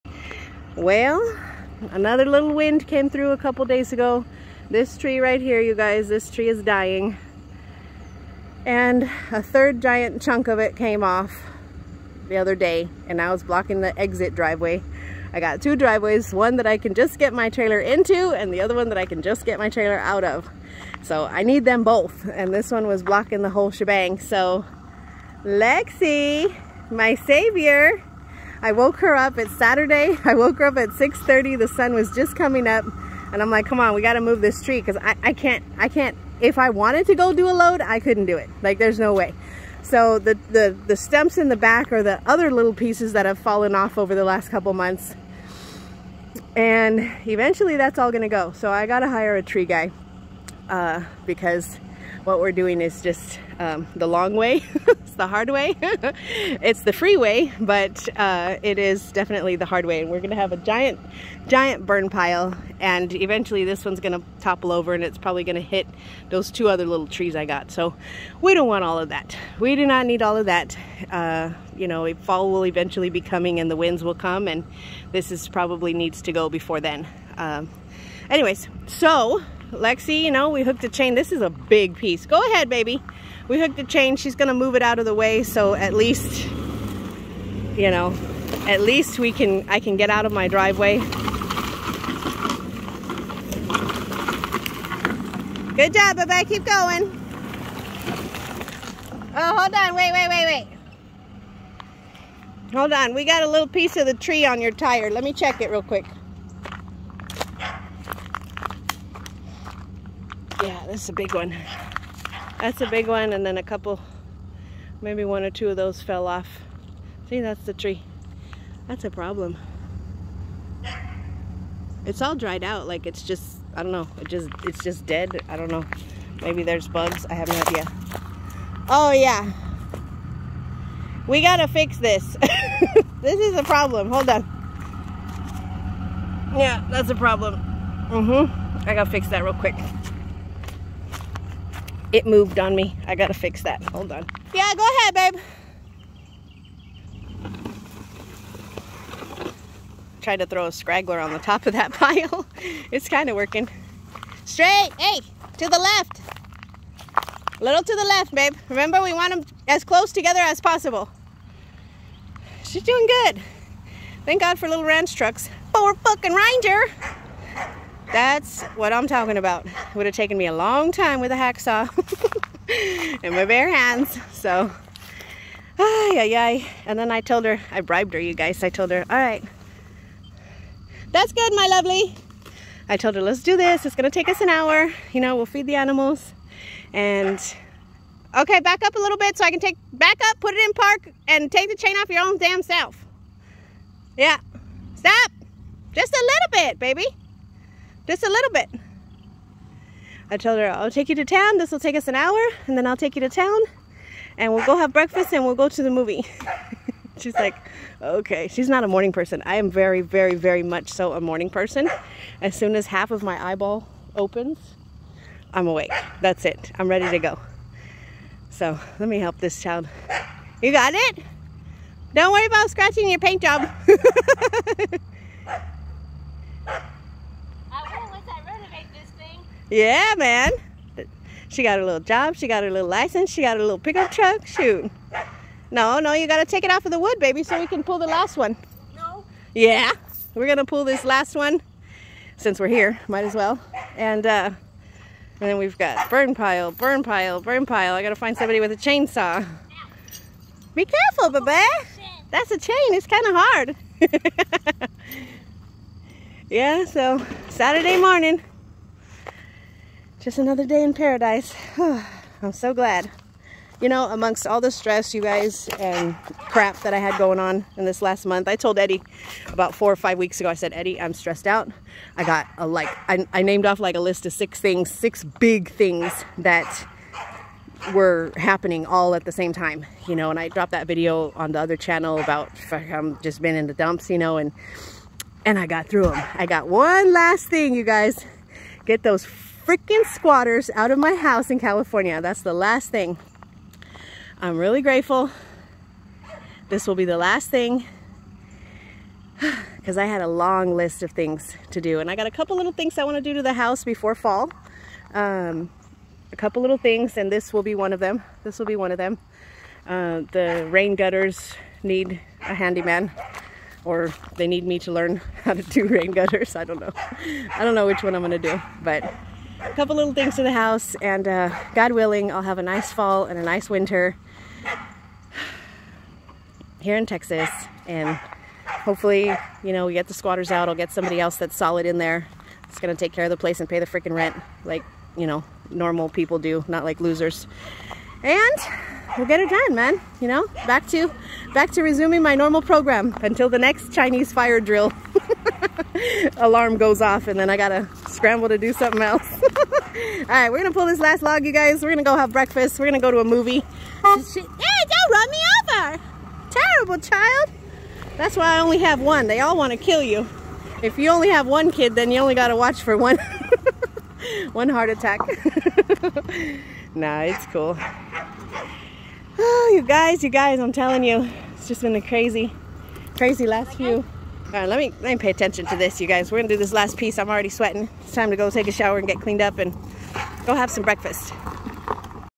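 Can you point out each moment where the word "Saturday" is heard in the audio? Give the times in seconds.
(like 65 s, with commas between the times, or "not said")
29 s, 257 s.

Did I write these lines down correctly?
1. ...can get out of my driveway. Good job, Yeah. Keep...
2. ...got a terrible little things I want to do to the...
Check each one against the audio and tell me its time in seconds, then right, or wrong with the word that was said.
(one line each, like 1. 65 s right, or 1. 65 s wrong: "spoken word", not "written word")
1. 89 s wrong: "Bebe", not "Yeah"
2. 302 s wrong: "couple", not "terrible".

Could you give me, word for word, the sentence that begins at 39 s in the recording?
So the, the, the stumps in the back are the other little pieces that have fallen off over the last couple months.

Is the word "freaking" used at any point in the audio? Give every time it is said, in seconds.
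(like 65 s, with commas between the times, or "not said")
289 s, 333 s.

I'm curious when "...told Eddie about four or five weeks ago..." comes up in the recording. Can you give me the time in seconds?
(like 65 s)
268 s.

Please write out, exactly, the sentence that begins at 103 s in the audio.
We got a little piece of the tree on your tire.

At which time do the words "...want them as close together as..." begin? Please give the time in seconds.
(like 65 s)
159 s.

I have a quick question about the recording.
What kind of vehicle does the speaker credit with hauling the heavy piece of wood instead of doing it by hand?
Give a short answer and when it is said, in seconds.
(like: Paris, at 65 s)
Ranger, at 166 s.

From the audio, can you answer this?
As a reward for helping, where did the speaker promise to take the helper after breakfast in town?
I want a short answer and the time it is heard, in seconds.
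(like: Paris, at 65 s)
the movie, at 205 s.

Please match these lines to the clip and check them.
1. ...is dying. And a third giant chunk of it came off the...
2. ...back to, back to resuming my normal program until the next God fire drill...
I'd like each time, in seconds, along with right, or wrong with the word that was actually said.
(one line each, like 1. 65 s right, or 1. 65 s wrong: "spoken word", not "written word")
1. 6 s right
2. 340 s wrong: "Chinese", not "God".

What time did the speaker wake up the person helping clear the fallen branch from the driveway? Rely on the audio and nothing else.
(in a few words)
6:30.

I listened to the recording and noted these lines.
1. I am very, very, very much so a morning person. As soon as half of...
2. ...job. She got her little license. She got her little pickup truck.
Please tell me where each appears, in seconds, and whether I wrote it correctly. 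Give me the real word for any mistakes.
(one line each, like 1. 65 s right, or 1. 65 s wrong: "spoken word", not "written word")
1. 209 s right
2. 232 s right.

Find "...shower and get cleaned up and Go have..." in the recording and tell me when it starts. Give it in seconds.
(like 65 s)
378 s.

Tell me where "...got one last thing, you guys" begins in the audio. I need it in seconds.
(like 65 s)
286 s.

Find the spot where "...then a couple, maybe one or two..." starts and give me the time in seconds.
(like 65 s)
113 s.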